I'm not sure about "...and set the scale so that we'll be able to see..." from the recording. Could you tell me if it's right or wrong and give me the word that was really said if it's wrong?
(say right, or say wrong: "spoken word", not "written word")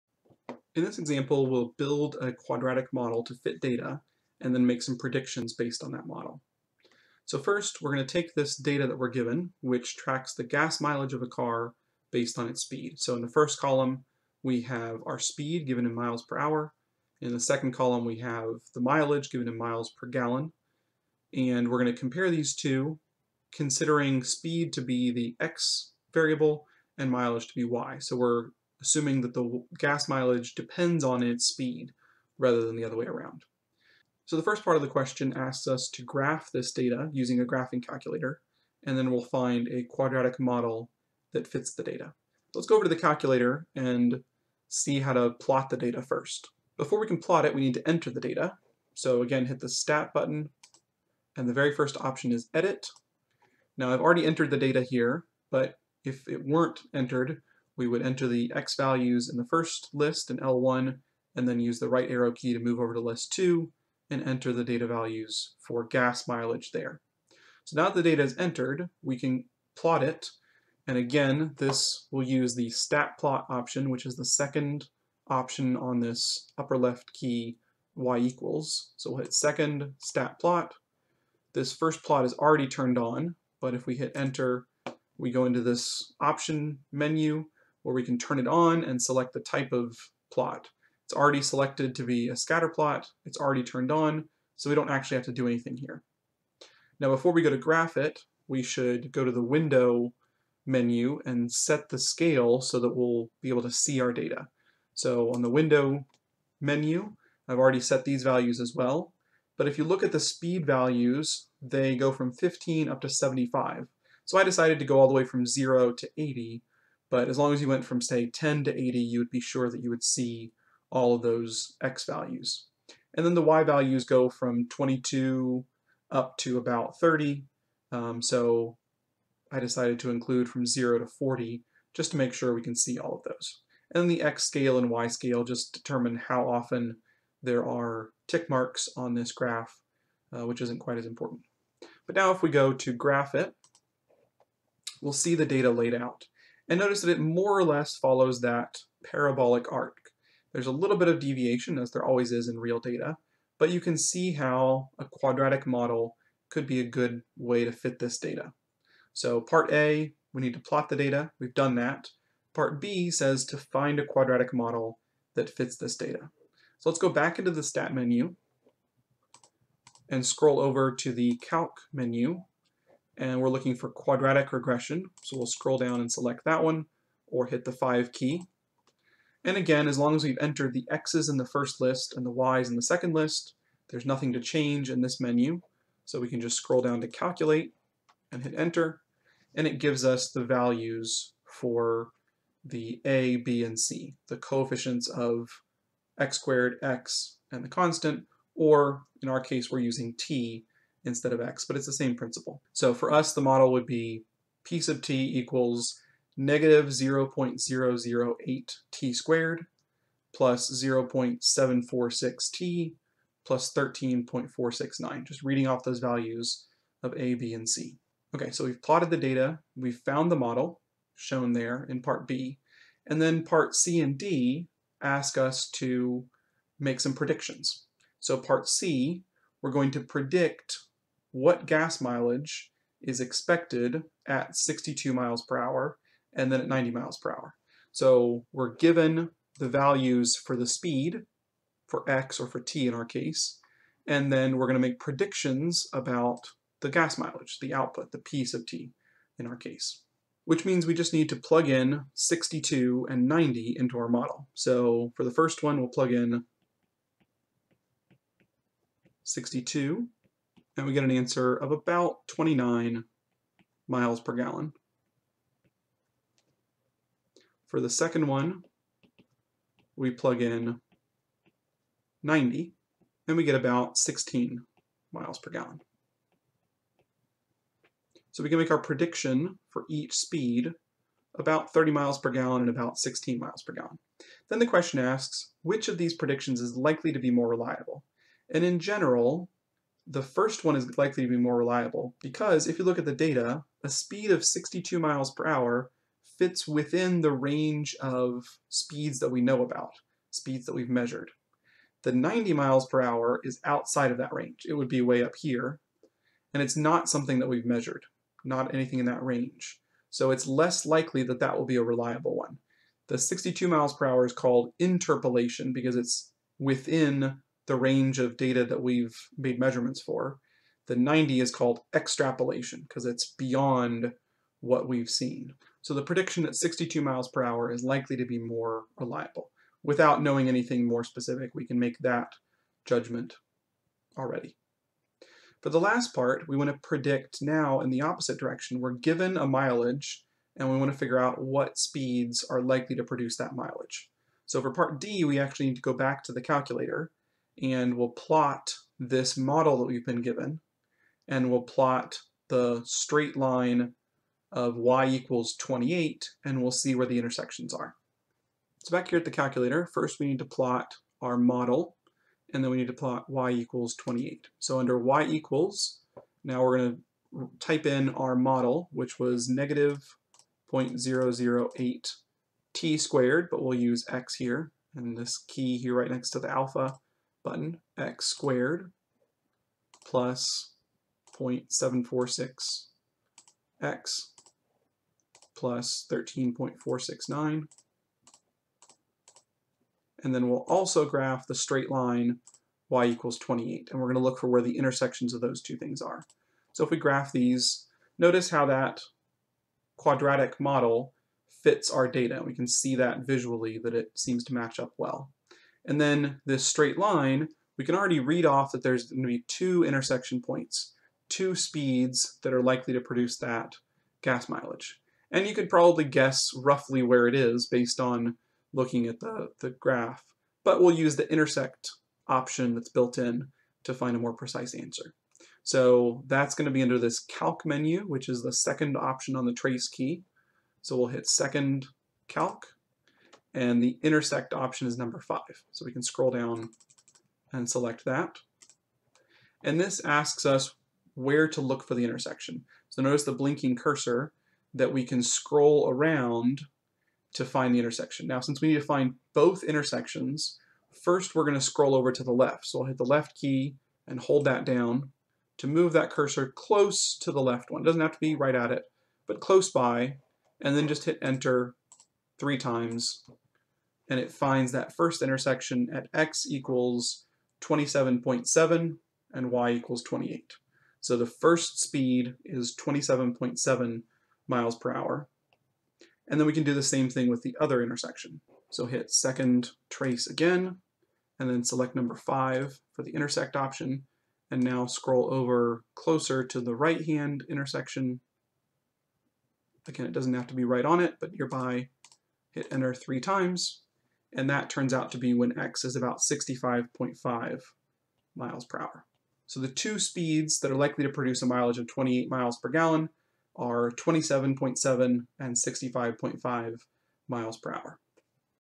right.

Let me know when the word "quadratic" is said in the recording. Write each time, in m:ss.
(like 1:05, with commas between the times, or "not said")
0:02, 0:39, 2:35, 2:44, 2:53, 6:39.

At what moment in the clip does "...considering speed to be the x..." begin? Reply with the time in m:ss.
0:23.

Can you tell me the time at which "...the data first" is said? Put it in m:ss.
0:45.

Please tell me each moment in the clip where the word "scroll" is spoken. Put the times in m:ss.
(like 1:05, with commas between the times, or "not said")
2:50, 2:55, 3:06, 7:16, 7:25, 7:31, 8:04.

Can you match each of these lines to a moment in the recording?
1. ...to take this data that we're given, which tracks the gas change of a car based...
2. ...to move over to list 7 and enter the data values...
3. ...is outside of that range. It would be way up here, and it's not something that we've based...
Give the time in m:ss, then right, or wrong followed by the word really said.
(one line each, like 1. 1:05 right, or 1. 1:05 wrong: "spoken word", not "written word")
1. 0:08 wrong: "mileage", not "change"
2. 1:02 wrong: "2", not "7"
3. 5:03 wrong: "measured", not "based".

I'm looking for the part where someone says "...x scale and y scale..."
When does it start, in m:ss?
2:14.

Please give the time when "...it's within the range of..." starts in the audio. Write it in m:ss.
5:15.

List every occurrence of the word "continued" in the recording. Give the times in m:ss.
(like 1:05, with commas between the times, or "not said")
not said.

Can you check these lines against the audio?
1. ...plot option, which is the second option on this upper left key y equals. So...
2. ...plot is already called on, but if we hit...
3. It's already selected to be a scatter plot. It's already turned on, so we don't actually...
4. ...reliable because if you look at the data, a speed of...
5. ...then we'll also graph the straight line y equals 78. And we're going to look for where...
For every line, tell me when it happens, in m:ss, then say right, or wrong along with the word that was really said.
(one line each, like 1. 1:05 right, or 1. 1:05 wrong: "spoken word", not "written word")
1. 1:13 right
2. 1:22 wrong: "turned", not "called"
3. 1:31 right
4. 4:51 right
5. 6:30 wrong: "28", not "78".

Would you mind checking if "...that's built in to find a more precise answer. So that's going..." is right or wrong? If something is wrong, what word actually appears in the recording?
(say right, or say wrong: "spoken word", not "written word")
right.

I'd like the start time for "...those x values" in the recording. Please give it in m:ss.
2:01.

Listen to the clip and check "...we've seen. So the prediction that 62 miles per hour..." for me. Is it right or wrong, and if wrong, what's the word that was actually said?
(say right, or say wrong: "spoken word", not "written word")
right.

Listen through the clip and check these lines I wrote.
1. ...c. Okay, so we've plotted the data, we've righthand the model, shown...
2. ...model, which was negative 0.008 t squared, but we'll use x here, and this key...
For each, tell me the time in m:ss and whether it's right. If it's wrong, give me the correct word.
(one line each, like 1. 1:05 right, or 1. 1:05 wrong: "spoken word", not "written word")
1. 3:37 wrong: "found", not "righthand"
2. 6:08 right.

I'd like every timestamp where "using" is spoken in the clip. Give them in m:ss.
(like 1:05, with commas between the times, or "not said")
0:37, 3:19.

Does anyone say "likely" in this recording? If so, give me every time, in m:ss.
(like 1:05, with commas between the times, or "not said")
4:46, 4:50, 5:10, 5:27, 5:42, 6:52, 8:20.